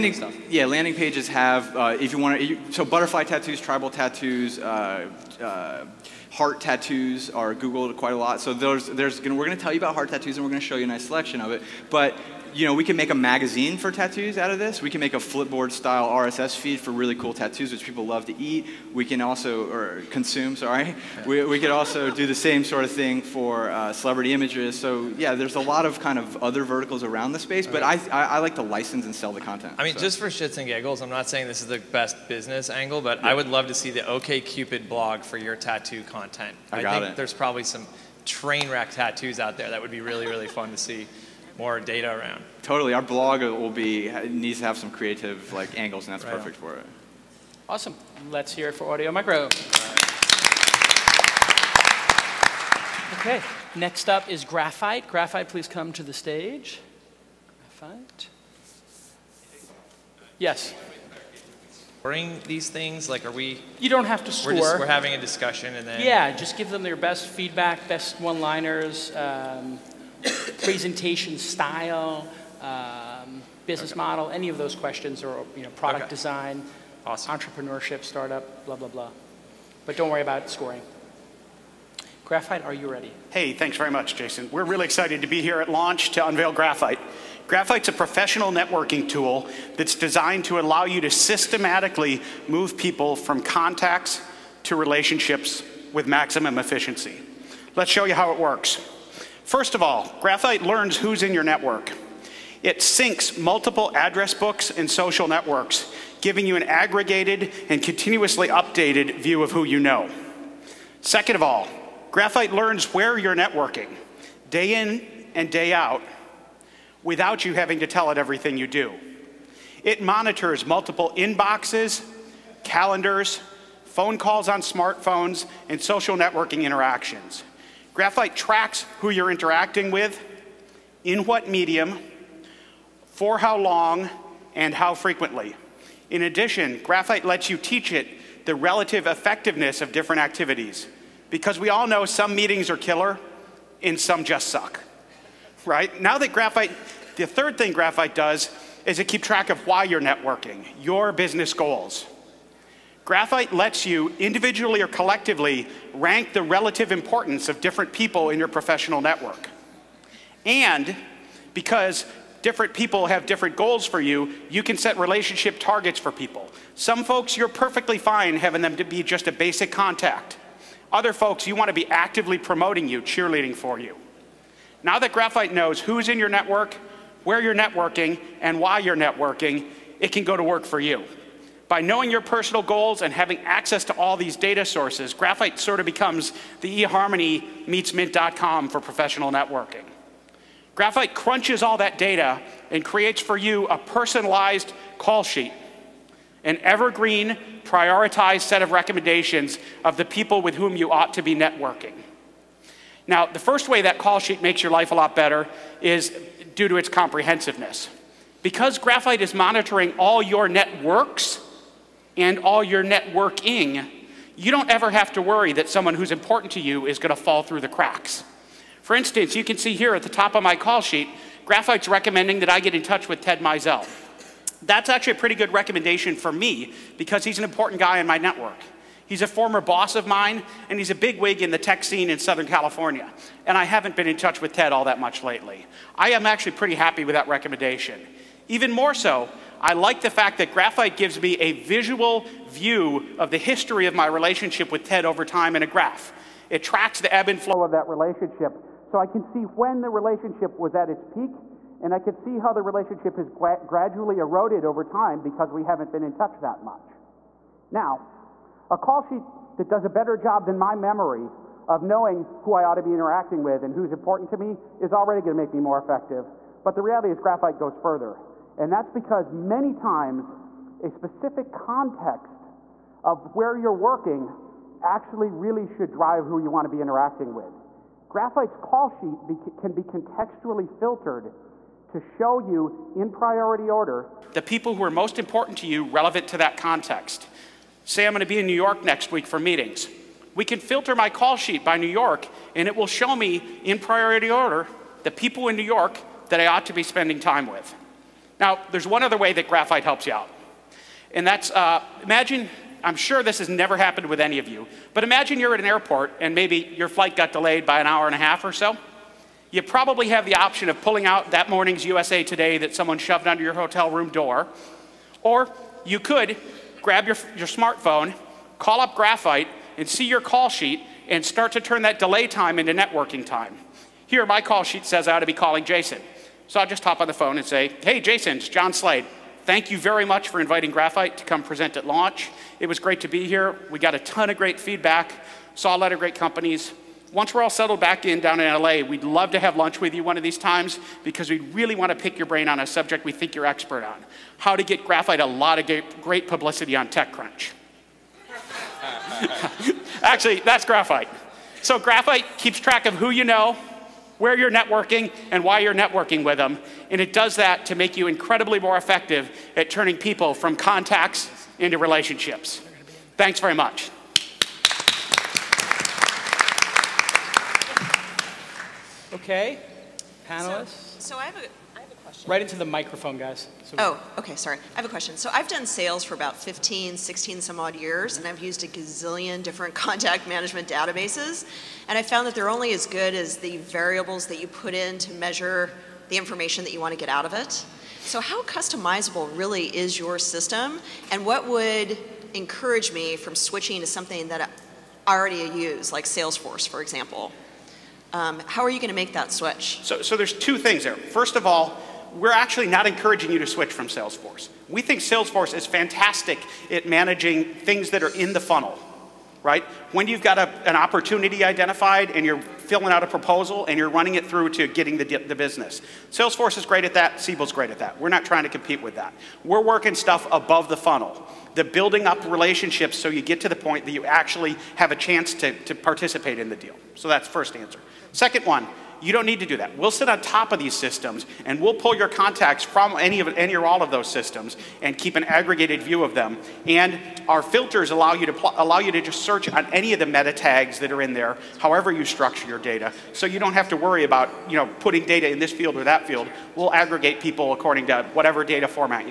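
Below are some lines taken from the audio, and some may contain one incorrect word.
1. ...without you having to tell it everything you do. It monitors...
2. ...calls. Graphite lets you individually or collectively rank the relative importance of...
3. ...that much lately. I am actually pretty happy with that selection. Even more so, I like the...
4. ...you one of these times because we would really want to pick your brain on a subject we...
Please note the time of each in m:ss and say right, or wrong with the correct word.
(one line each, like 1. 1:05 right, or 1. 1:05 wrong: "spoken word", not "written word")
1. 1:57 right
2. 2:31 wrong: "goals", not "calls"
3. 3:54 wrong: "recommendation", not "selection"
4. 5:39 right.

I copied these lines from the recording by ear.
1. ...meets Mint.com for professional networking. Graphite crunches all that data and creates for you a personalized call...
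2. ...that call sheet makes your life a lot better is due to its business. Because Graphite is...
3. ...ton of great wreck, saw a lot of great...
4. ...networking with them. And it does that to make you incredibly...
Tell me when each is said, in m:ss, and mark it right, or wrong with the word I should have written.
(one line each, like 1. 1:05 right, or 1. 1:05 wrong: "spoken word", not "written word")
1. 3:07 right
2. 3:23 wrong: "comprehensiveness", not "business"
3. 5:33 wrong: "feedback", not "wreck"
4. 5:55 right.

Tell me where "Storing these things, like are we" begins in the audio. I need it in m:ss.
1:01.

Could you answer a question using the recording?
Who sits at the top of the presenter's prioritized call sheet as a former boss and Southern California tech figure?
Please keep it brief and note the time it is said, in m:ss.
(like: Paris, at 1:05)
Ted Mizell, at 3:43.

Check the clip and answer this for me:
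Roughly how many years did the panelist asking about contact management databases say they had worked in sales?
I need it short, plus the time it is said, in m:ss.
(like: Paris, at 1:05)
15 to 16, at 6:16.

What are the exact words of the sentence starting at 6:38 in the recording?
Um, how are you going to make that switch?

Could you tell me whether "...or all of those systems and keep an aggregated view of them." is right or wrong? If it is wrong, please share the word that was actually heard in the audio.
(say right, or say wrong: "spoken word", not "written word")
right.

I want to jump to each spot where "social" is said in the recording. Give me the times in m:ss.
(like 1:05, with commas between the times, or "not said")
1:44, 2:05.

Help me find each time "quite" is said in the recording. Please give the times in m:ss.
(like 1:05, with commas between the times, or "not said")
0:07.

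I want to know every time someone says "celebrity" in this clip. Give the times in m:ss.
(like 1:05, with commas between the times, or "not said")
0:23.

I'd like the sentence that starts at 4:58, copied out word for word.
Now, there's one other way that graphite helps you out.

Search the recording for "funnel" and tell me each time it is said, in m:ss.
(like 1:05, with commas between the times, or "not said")
6:48, 7:00.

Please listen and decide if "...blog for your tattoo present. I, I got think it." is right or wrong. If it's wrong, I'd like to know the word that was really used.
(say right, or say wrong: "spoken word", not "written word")
wrong: "content", not "present".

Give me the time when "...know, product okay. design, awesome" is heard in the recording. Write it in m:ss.
1:15.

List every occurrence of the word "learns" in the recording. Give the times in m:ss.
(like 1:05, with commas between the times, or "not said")
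1:40, 1:52.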